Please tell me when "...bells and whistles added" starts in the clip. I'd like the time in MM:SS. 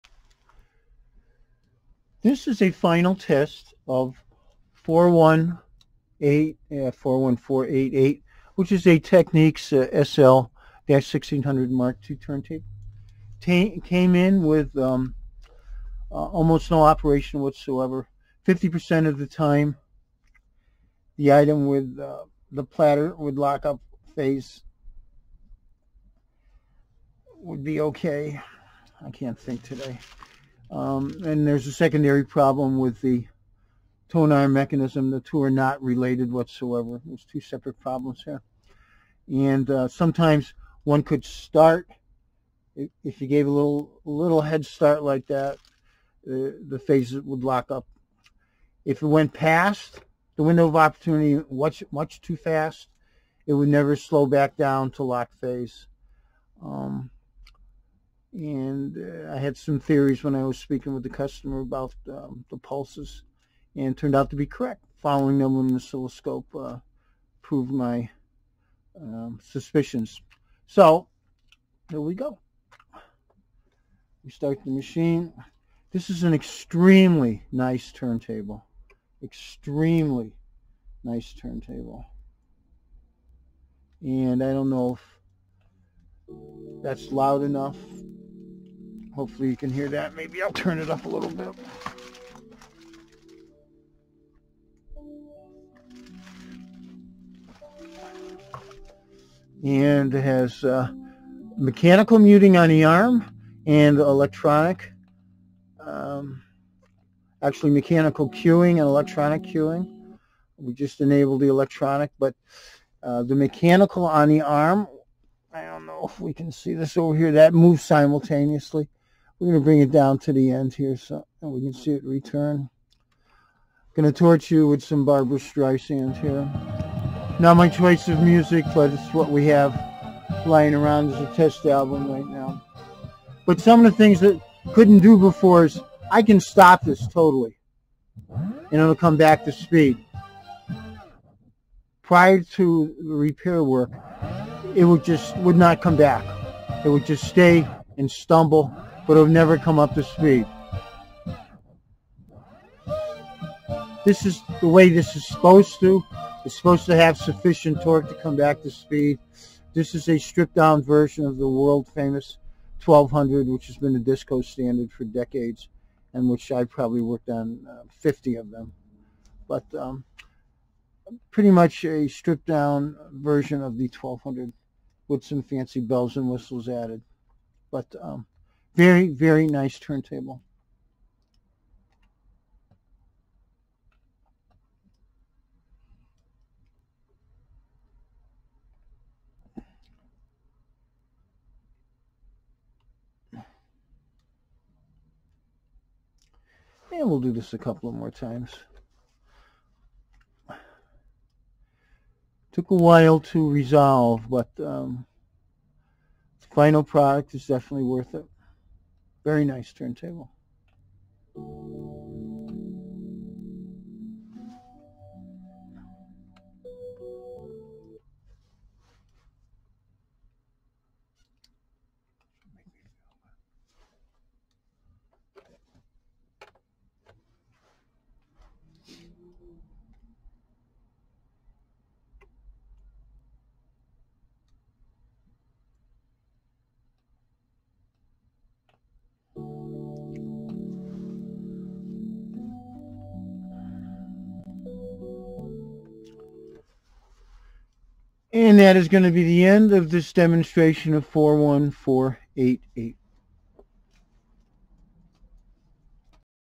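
02:55.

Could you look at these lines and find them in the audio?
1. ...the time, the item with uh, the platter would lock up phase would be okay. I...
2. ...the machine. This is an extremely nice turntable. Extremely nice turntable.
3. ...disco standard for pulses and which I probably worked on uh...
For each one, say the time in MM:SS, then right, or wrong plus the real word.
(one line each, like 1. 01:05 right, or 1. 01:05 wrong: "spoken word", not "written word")
1. 00:19 right
2. 01:14 right
3. 02:43 wrong: "decades", not "pulses".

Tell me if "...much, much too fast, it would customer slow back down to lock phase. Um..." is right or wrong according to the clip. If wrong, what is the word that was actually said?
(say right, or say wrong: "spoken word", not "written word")
wrong: "never", not "customer".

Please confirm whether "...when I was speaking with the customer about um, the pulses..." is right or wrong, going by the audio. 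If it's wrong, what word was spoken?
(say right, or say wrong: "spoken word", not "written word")
right.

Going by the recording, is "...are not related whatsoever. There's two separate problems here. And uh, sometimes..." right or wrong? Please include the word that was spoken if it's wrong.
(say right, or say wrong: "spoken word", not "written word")
right.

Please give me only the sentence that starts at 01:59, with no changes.
We're going to bring it down to the end here so we can see it return.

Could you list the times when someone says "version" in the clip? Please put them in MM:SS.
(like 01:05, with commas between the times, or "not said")
02:40, 02:53.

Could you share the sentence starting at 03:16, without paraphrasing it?
And we'll do this a couple of more times.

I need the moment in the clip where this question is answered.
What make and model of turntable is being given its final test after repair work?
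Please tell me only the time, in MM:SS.
00:08.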